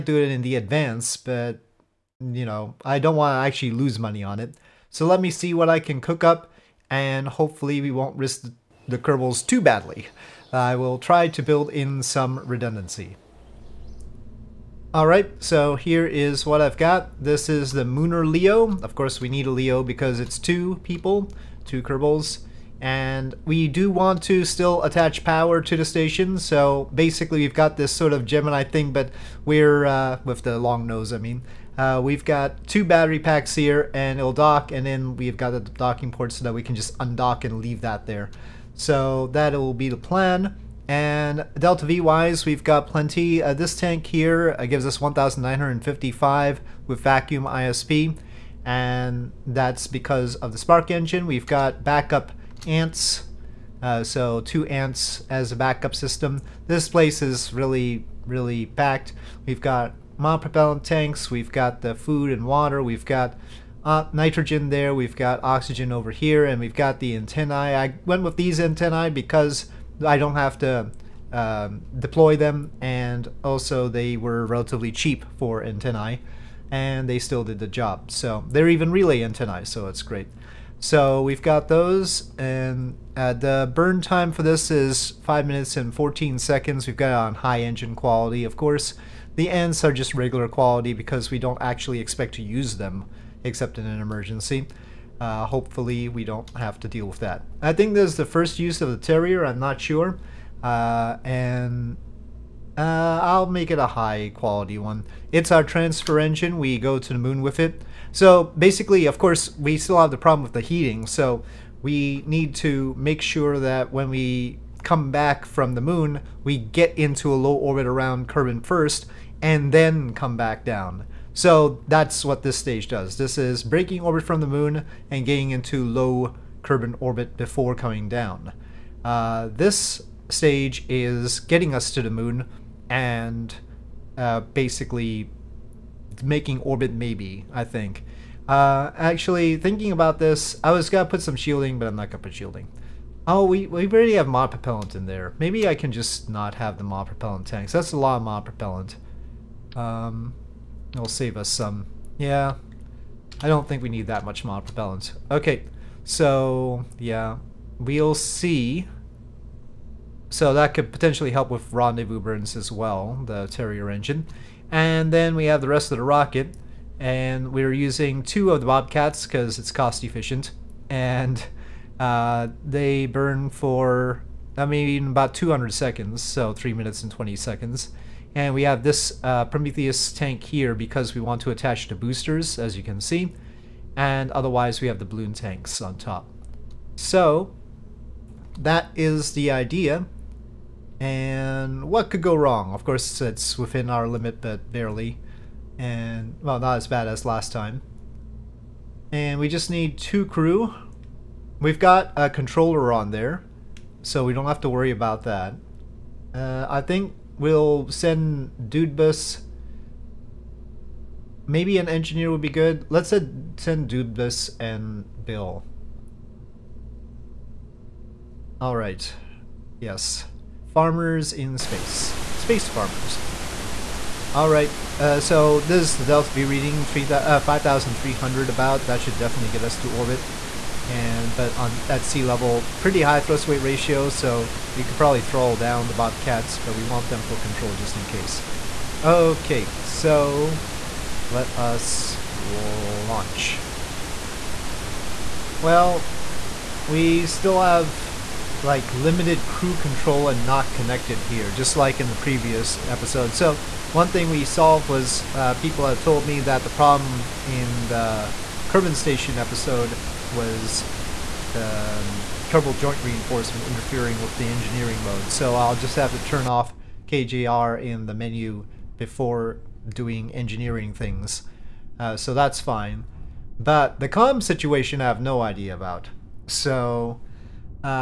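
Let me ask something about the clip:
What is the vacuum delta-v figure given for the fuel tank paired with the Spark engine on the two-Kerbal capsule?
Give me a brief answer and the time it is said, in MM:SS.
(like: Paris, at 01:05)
1955, at 00:44.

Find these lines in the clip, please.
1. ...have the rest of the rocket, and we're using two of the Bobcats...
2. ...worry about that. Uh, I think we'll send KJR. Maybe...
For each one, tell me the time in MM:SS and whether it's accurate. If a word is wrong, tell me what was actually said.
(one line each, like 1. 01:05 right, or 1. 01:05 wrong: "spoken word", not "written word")
1. 02:45 right
2. 03:24 wrong: "Dudebus", not "KJR".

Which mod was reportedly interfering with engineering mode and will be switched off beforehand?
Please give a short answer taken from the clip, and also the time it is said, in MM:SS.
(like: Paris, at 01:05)
Kerbal Joint Reinforcement, at 04:22.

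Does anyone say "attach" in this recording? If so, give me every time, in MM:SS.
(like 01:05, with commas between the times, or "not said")
00:24, 03:01.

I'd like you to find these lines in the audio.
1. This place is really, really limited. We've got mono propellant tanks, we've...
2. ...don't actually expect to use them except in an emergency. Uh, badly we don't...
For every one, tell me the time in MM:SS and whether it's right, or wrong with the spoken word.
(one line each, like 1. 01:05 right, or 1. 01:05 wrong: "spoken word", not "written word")
1. 00:56 wrong: "packed", not "limited"
2. 01:31 wrong: "hopefully", not "badly".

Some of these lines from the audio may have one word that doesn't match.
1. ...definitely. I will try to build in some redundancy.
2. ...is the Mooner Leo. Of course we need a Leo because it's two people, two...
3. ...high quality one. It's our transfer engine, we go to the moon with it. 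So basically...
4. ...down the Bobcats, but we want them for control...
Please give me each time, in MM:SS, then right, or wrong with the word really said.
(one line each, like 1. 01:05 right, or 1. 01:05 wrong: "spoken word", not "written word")
1. 00:09 wrong: "badly", not "definitely"
2. 00:17 right
3. 01:43 right
4. 03:55 right.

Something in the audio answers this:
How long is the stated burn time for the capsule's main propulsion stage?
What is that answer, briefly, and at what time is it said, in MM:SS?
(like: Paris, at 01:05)
5 minutes 14 seconds, at 01:25.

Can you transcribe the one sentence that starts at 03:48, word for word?
That should definitely get us to orbit.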